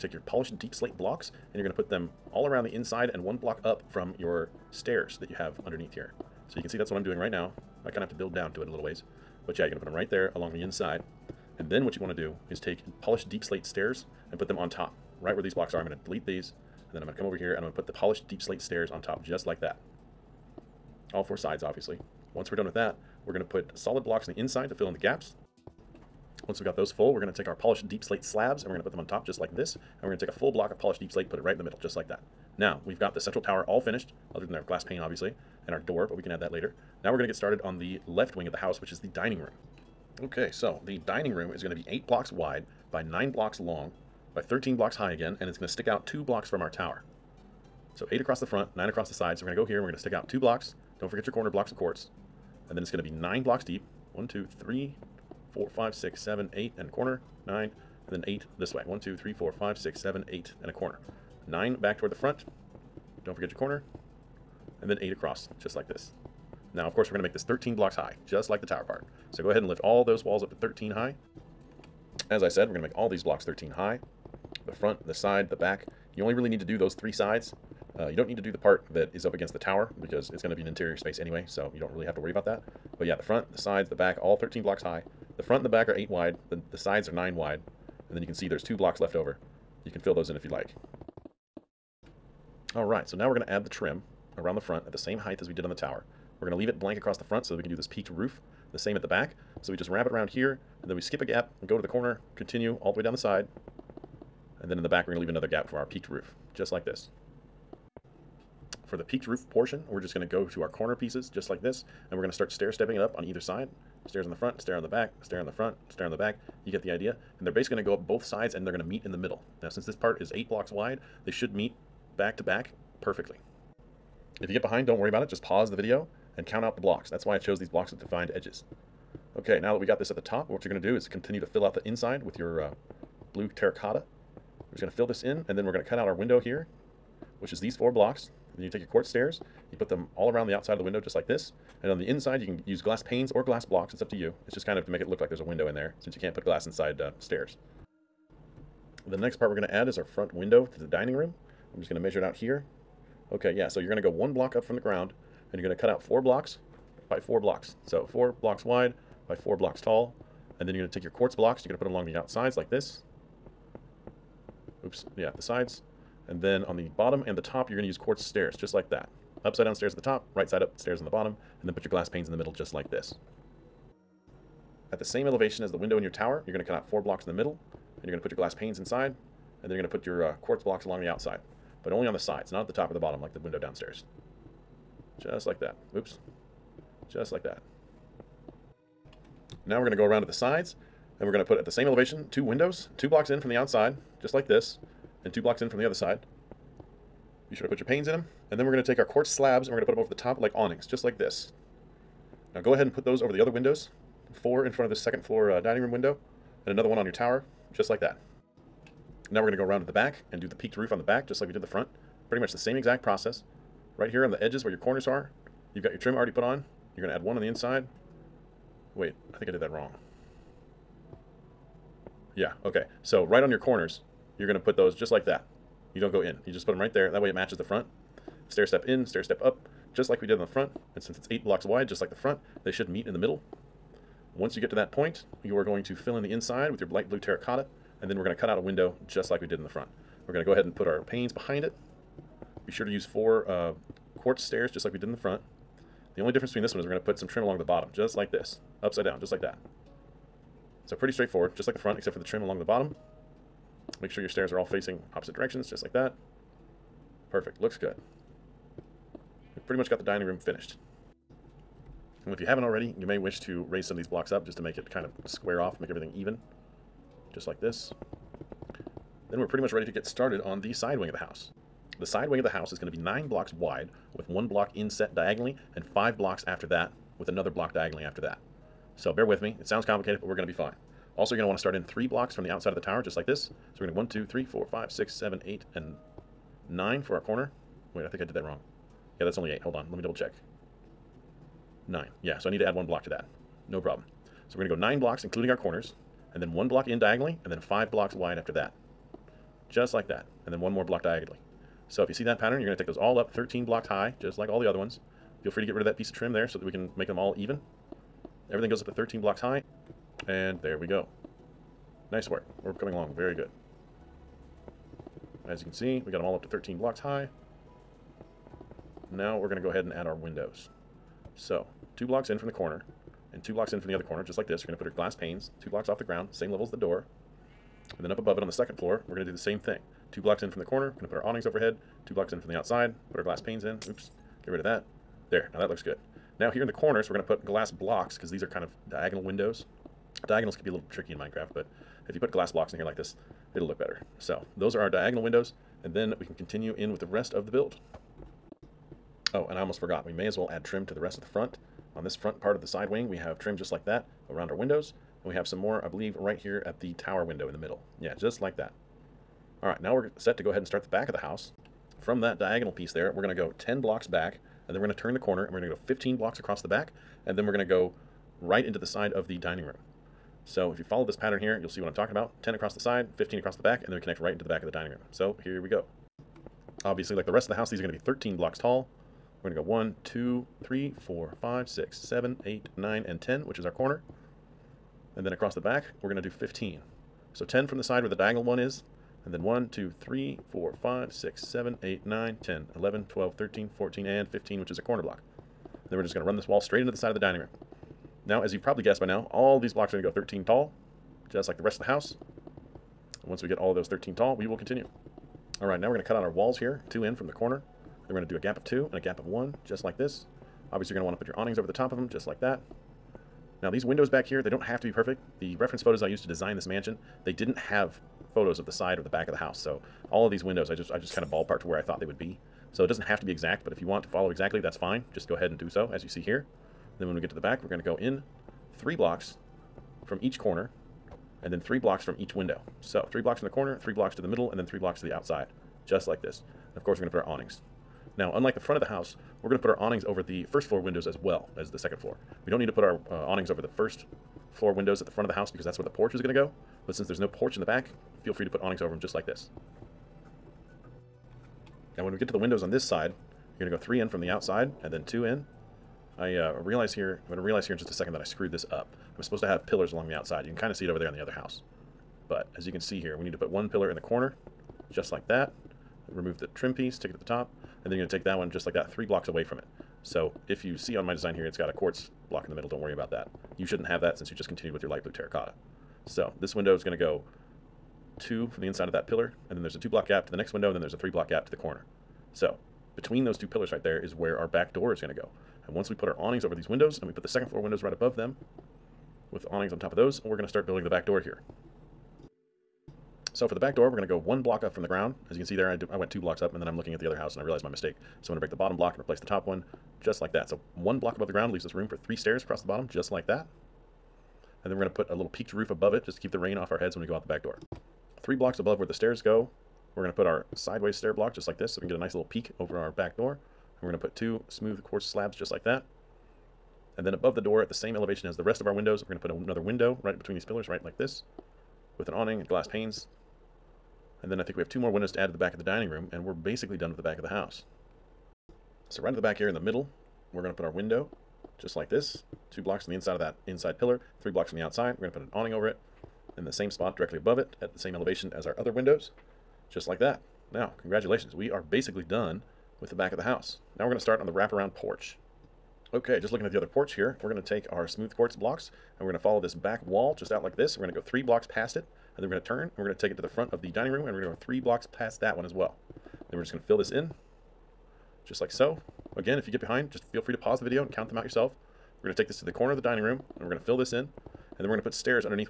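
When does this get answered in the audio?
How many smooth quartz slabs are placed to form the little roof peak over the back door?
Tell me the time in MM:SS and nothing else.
08:34.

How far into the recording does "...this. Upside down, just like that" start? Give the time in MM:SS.
04:08.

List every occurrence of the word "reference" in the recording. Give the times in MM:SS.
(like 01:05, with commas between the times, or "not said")
06:55.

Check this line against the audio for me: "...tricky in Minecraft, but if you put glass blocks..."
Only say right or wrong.
right.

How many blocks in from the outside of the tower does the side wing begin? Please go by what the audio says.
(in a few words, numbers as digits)
3.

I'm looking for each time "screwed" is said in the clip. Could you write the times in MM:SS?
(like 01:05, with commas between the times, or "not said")
07:38.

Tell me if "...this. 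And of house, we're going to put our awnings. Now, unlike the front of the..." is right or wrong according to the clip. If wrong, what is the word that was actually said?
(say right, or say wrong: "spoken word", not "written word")
wrong: "course", not "house".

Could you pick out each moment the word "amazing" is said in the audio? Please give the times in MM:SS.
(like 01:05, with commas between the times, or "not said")
not said.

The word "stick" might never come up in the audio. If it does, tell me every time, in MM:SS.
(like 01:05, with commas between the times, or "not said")
00:45, 00:50.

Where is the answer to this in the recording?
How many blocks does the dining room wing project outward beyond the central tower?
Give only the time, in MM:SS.
00:45.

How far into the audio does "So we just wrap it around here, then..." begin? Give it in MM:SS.
01:39.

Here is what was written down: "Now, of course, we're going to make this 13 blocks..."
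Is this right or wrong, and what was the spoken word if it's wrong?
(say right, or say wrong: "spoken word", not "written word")
right.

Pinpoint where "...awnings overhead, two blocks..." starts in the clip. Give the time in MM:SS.
05:31.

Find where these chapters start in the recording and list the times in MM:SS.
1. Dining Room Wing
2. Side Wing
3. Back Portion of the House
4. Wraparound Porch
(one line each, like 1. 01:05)
1. 00:37
2. 04:28
3. 05:59
4. 09:02.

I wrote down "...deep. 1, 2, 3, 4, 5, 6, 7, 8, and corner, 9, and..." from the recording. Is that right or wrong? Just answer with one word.
right.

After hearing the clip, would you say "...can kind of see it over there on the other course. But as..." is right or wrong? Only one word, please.
wrong.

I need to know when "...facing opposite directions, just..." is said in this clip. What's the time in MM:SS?
04:14.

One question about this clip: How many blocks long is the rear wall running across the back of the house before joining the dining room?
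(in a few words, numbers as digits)
15.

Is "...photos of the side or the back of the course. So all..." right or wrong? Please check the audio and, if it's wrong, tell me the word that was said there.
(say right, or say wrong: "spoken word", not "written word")
wrong: "house", not "course".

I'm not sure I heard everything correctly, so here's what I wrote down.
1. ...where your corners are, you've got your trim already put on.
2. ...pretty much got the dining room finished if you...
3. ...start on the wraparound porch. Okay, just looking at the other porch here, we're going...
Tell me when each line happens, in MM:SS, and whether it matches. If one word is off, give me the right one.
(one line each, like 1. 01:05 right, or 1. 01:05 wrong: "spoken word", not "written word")
1. 03:34 right
2. 04:19 right
3. 09:03 right.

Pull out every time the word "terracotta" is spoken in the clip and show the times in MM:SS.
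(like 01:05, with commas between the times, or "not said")
02:13, 03:57, 07:55.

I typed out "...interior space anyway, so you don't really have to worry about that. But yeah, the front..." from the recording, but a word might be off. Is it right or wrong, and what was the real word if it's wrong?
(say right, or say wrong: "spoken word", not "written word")
right.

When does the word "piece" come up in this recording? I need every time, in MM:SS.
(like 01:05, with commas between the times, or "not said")
01:50, 05:05, 06:02, 07:46.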